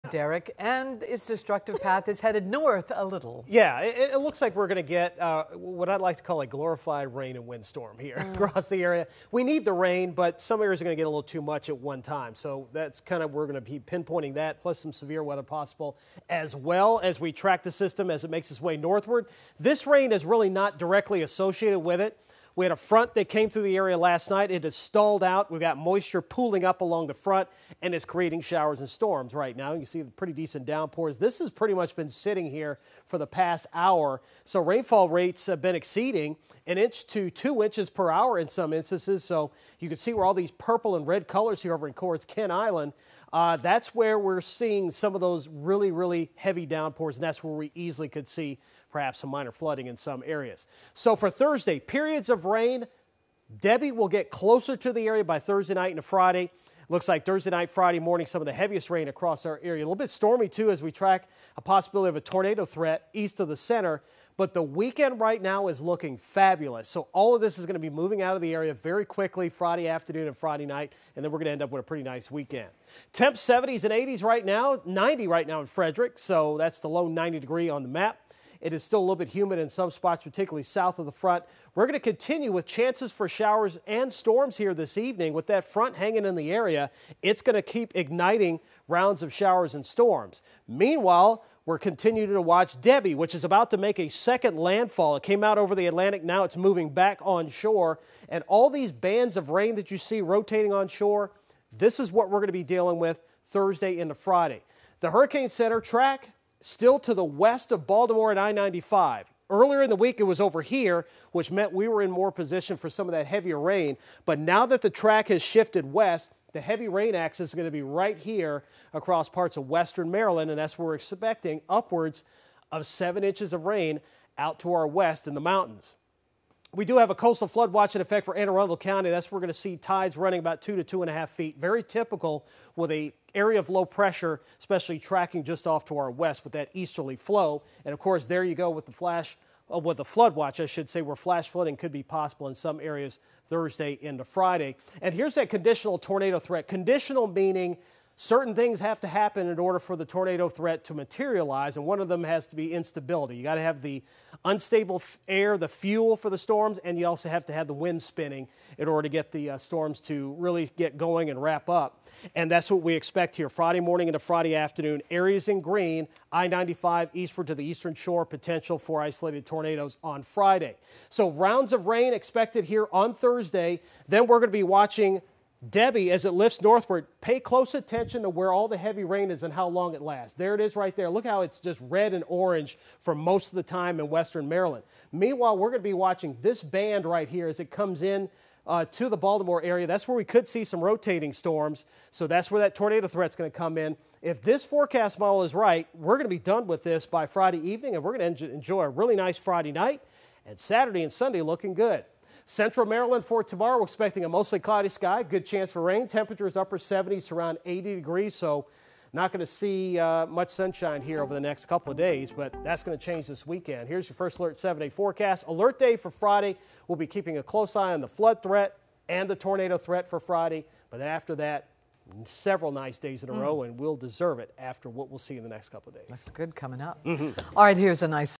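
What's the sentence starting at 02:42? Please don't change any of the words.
And that's what we expect here Friday morning into Friday afternoon.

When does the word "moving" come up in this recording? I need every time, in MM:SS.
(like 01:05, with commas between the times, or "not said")
01:07, 01:36.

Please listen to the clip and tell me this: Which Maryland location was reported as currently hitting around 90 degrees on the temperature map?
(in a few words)
Frederick.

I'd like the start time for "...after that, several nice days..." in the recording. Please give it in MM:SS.
03:41.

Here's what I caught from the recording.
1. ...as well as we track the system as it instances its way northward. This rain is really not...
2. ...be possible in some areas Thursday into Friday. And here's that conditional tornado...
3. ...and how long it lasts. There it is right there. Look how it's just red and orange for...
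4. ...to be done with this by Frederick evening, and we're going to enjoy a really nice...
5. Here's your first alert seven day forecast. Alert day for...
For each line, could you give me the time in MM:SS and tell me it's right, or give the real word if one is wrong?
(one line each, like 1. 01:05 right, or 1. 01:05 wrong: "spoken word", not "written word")
1. 00:16 wrong: "makes", not "instances"
2. 02:21 right
3. 02:59 right
4. 03:16 wrong: "Friday", not "Frederick"
5. 03:33 right.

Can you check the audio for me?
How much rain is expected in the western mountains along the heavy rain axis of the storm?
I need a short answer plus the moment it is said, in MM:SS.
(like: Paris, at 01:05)
7 inches, at 02:02.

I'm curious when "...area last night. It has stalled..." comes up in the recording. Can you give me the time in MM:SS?
00:23.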